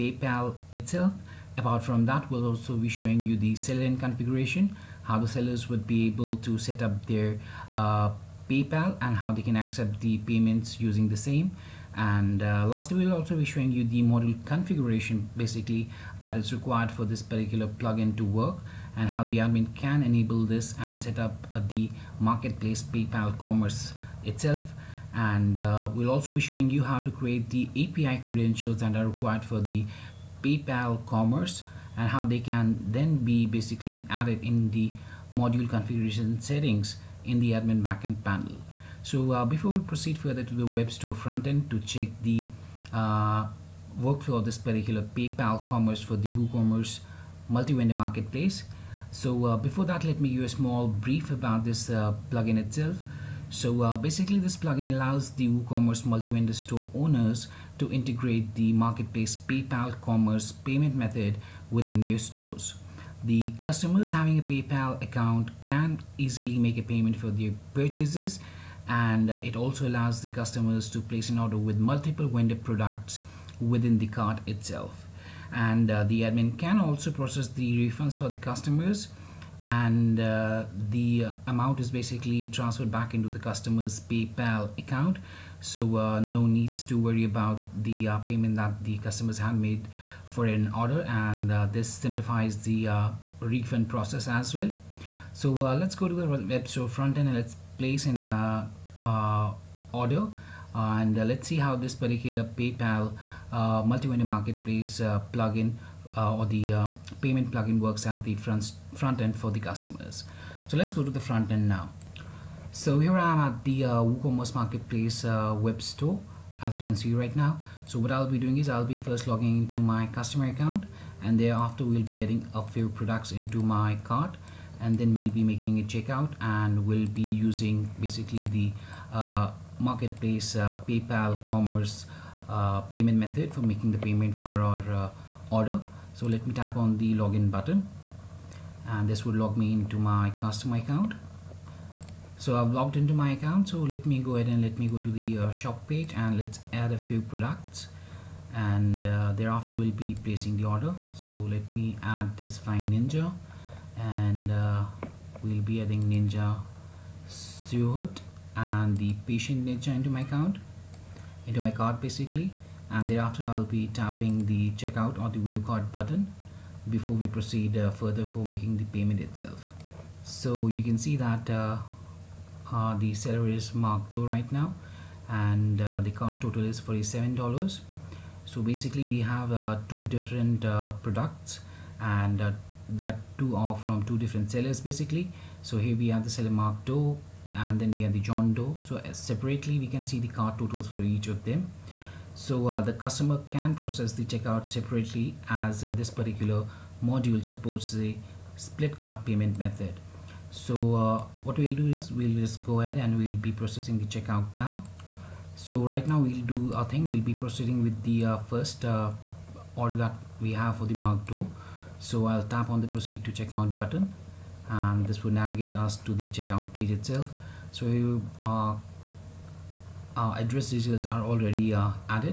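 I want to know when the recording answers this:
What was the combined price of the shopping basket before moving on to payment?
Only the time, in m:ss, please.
2:56.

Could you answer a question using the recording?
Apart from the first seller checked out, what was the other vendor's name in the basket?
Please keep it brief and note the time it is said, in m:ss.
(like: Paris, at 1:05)
John Doe, at 3:08.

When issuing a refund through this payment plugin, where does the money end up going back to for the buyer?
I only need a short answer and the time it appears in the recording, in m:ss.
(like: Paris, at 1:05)
customer's PayPal account, at 1:23.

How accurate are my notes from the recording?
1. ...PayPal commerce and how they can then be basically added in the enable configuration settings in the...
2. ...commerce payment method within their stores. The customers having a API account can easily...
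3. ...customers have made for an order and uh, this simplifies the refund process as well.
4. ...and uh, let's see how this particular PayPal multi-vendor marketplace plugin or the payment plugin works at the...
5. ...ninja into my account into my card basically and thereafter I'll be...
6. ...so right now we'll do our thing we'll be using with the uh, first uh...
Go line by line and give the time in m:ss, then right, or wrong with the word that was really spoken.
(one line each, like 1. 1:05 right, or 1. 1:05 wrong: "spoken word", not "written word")
1. 0:30 wrong: "module", not "enable"
2. 1:00 wrong: "PayPal", not "API"
3. 1:28 right
4. 1:40 right
5. 2:39 right
6. 3:25 wrong: "proceeding", not "using".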